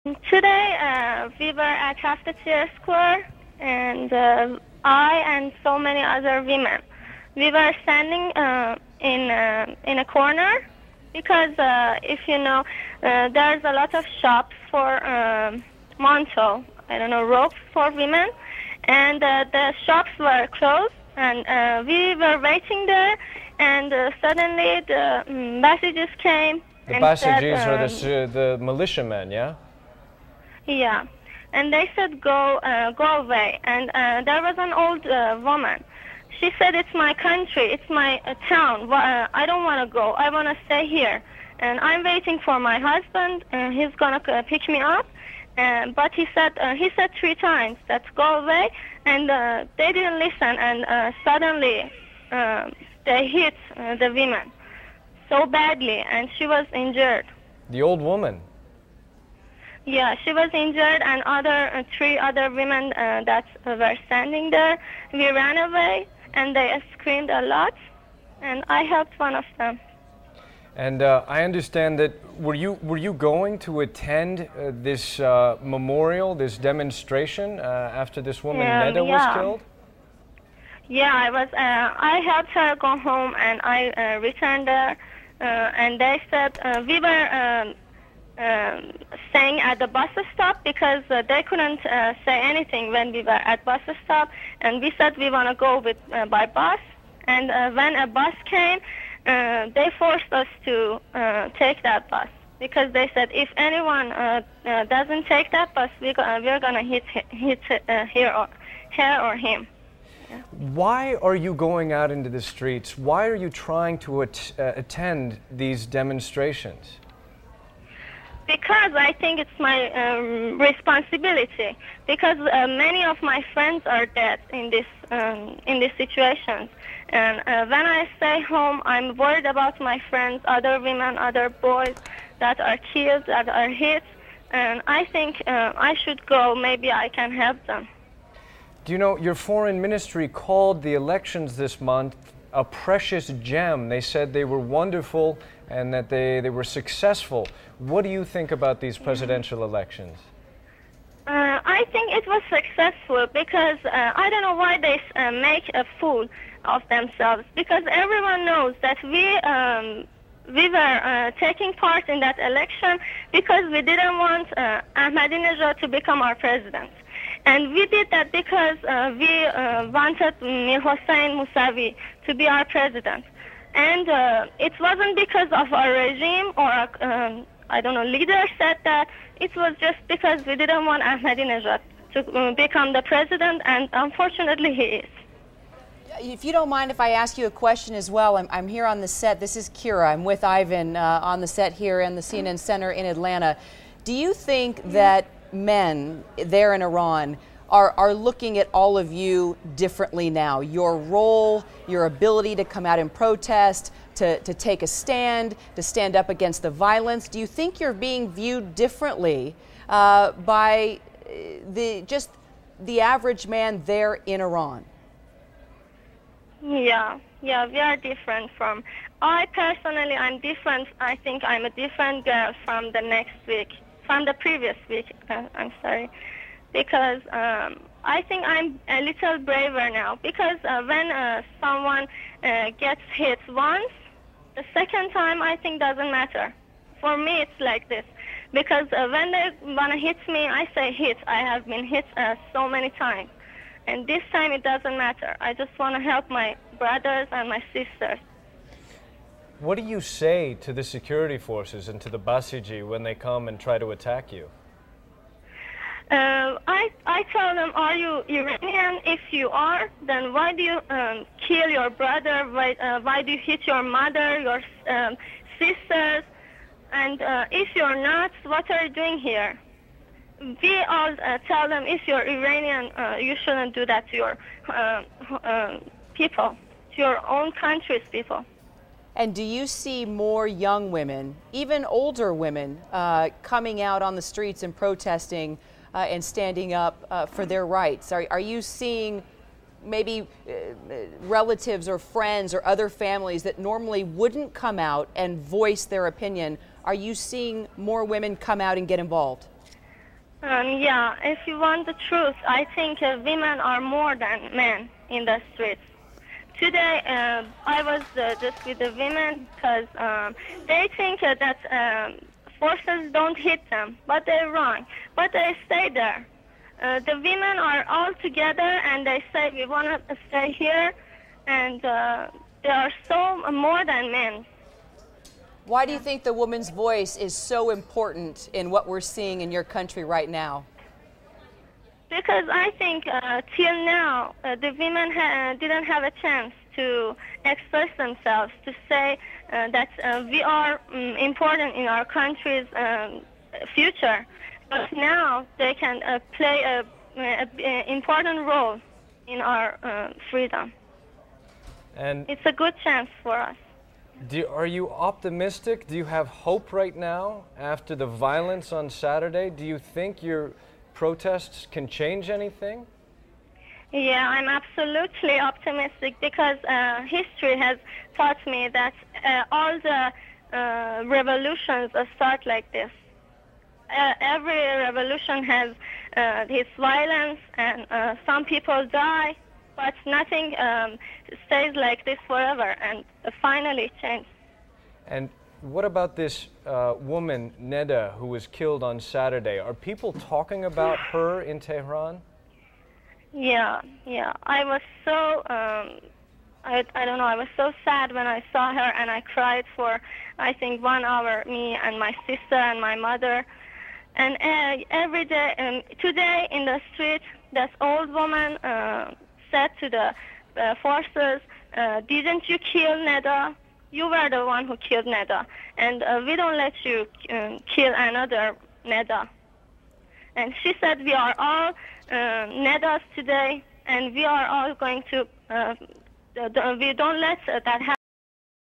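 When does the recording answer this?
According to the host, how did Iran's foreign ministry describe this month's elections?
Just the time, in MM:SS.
02:22.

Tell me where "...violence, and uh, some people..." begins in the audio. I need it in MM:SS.
06:16.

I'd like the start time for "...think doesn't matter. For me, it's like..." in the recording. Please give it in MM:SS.
03:55.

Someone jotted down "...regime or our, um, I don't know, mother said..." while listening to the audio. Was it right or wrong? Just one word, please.
wrong.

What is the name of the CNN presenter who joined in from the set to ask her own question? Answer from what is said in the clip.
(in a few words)
Kyra.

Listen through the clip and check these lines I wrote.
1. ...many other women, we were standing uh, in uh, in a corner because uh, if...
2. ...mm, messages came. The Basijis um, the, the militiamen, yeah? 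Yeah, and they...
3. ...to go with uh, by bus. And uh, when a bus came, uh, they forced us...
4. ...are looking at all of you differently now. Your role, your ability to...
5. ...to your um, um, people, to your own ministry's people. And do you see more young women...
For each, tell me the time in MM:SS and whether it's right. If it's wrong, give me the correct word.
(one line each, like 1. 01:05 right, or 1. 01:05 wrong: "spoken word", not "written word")
1. 00:05 right
2. 00:25 right
3. 01:35 right
4. 03:17 right
5. 04:34 wrong: "country", not "ministry".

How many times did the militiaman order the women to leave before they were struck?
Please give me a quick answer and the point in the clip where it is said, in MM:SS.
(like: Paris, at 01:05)
3, at 00:47.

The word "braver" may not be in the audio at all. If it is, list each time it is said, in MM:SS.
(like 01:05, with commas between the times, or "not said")
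03:49.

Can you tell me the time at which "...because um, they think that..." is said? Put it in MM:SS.
05:09.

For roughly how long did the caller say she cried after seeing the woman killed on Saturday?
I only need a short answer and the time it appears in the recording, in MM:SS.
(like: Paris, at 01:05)
1 hour, at 06:40.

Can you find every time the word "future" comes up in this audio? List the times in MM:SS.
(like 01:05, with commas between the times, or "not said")
05:43.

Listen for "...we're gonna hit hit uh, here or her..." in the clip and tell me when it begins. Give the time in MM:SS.
01:46.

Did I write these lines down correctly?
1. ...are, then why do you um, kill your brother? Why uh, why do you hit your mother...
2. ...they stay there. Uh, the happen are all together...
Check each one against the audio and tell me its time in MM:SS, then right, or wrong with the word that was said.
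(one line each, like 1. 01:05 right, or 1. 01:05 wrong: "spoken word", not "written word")
1. 04:19 right
2. 05:15 wrong: "women", not "happen".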